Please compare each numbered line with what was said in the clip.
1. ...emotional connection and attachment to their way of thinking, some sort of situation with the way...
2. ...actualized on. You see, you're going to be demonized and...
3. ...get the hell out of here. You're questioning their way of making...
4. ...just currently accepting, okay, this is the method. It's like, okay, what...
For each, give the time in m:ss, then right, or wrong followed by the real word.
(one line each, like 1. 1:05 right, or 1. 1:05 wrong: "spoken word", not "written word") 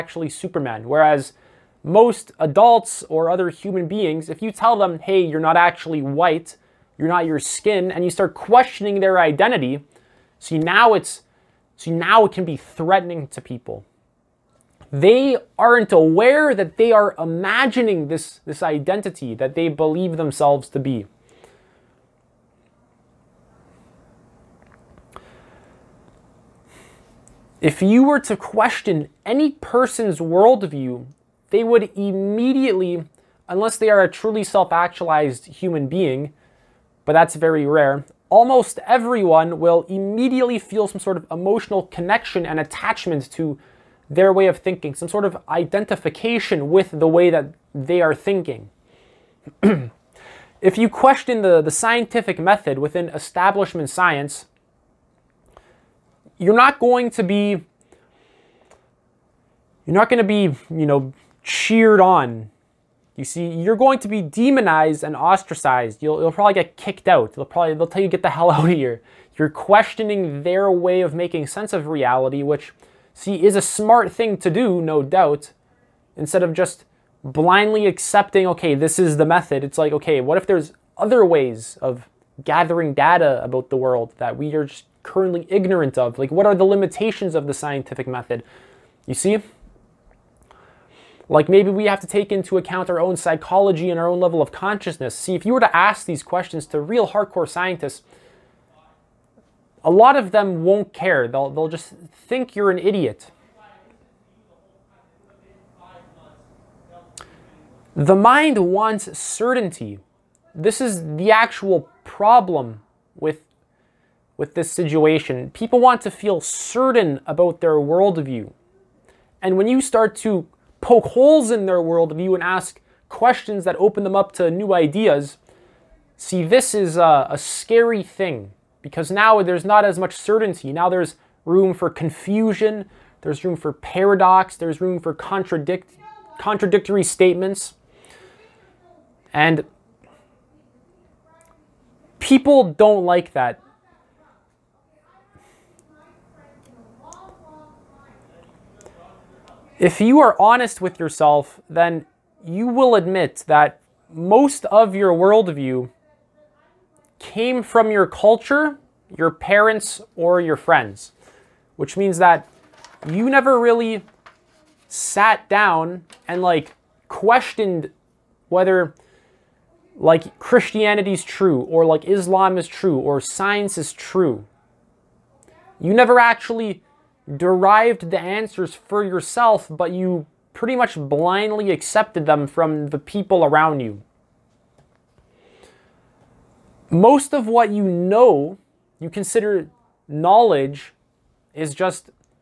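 1. 0:41 wrong: "identification", not "situation"
2. 1:01 wrong: "cheered", not "actualized"
3. 1:08 right
4. 1:16 wrong: "blindly", not "currently".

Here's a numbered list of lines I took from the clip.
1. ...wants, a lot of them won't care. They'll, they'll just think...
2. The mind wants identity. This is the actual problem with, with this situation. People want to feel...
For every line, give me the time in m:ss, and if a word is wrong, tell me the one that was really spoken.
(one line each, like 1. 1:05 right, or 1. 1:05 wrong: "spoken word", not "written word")
1. 1:37 wrong: "scientists", not "wants"
2. 1:47 wrong: "certainty", not "identity".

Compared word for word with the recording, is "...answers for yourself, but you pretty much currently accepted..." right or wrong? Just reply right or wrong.
wrong.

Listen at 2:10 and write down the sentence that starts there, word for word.
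Now there's room for confusion, there's room for paradox, there's room for contradict contradictory statements.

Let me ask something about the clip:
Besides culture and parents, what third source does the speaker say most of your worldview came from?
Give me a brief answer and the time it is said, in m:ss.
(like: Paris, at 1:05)
your friends, at 2:40.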